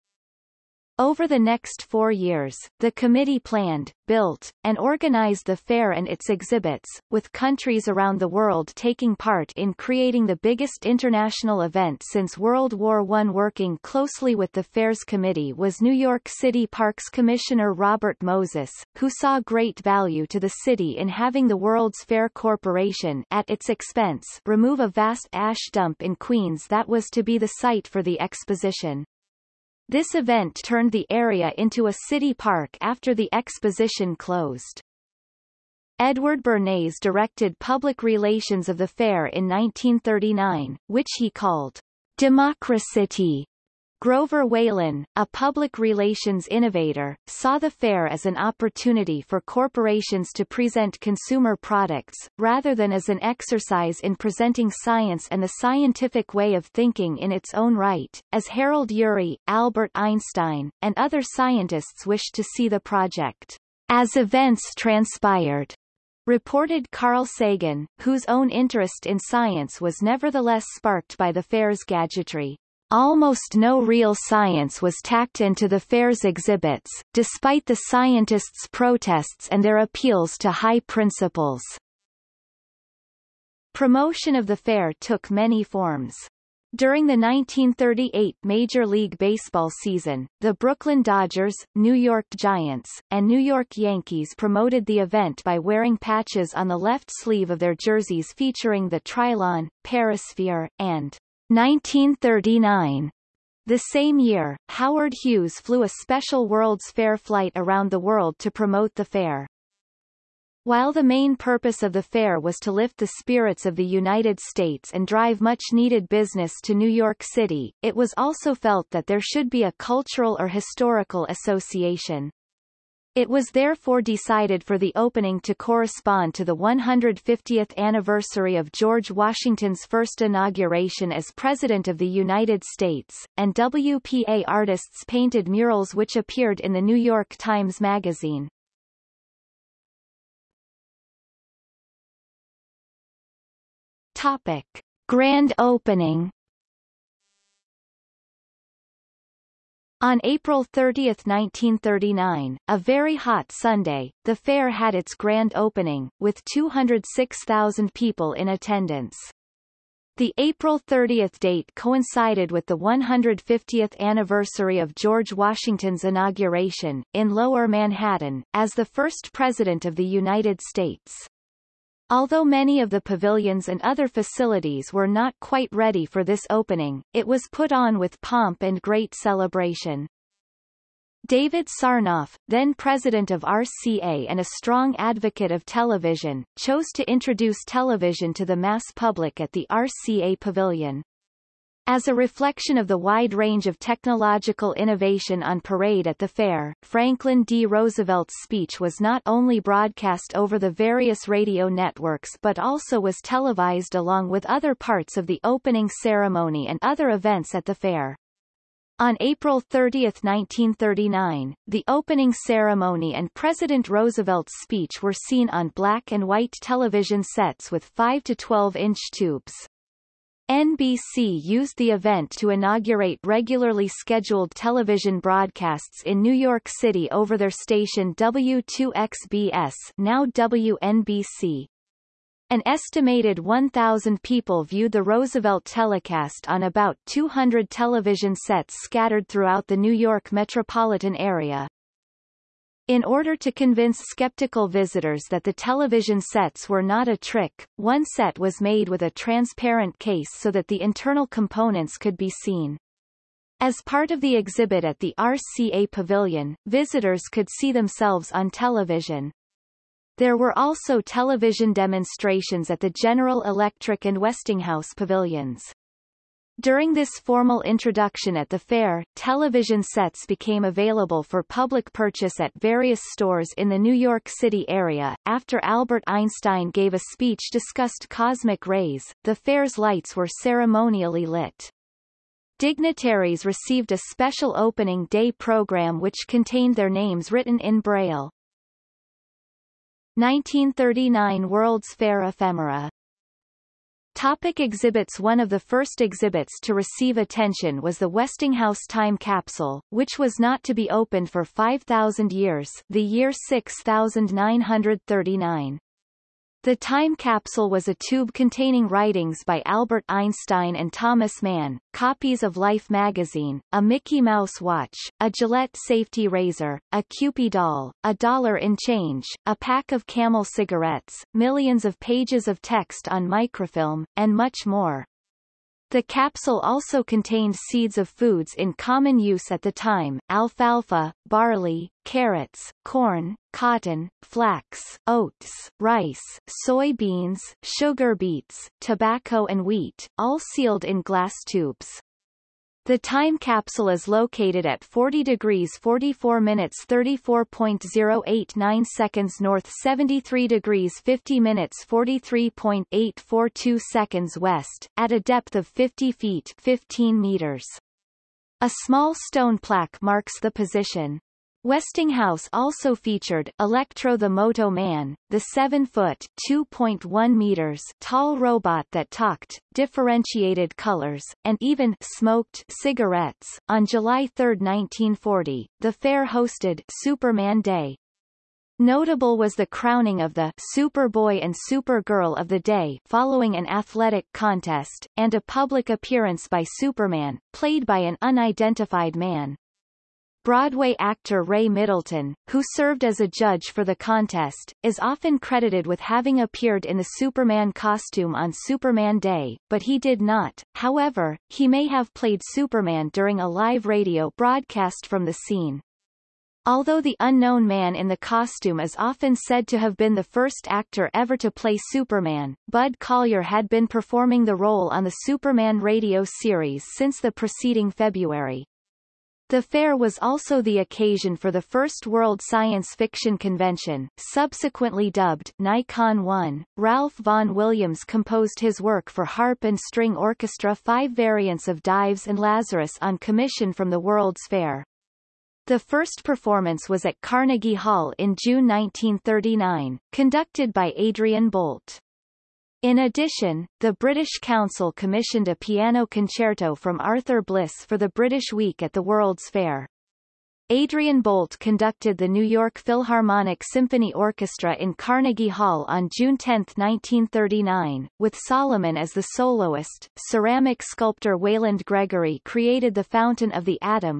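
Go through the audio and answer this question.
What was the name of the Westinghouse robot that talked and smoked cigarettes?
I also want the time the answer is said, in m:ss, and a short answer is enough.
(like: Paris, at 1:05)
Electro the Moto Man, at 6:03.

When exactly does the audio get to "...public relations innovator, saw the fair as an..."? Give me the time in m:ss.
0:45.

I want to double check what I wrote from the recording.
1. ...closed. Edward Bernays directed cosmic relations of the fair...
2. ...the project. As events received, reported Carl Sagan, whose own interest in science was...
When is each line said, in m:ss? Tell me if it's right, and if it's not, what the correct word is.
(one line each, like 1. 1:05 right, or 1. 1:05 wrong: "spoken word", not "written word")
1. 0:34 wrong: "public", not "cosmic"
2. 1:02 wrong: "transpired", not "received".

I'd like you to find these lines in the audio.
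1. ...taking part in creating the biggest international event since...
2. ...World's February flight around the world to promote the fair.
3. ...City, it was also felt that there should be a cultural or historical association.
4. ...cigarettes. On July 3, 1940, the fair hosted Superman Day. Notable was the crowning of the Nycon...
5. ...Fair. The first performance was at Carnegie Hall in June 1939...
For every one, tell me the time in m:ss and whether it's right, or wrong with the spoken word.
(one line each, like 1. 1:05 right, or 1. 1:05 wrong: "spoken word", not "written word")
1. 0:08 right
2. 1:46 wrong: "Fair", not "February"
3. 1:57 right
4. 6:12 wrong: "Superboy", not "Nycon"
5. 7:14 right.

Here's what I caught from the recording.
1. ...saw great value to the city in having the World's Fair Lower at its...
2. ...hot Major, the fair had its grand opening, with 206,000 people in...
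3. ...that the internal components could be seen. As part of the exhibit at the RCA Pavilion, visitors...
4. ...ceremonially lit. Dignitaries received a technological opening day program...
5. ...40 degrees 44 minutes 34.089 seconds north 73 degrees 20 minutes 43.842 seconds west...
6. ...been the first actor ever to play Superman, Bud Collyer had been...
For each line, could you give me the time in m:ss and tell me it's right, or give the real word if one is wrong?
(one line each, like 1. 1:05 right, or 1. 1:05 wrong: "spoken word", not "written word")
1. 0:19 wrong: "Corporation", not "Lower"
2. 2:33 wrong: "Sunday", not "Major"
3. 4:10 right
4. 4:40 wrong: "special", not "technological"
5. 5:44 wrong: "50", not "20"
6. 6:49 right.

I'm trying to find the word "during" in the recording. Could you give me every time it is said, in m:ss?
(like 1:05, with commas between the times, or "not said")
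1:26, 4:26, 6:43.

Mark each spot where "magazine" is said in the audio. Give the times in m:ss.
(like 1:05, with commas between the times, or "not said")
2:17, 5:12.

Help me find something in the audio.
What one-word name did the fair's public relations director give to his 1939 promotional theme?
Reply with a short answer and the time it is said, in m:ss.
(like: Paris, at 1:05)
Democracy, at 0:42.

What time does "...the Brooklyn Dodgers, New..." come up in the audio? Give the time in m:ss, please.
1:30.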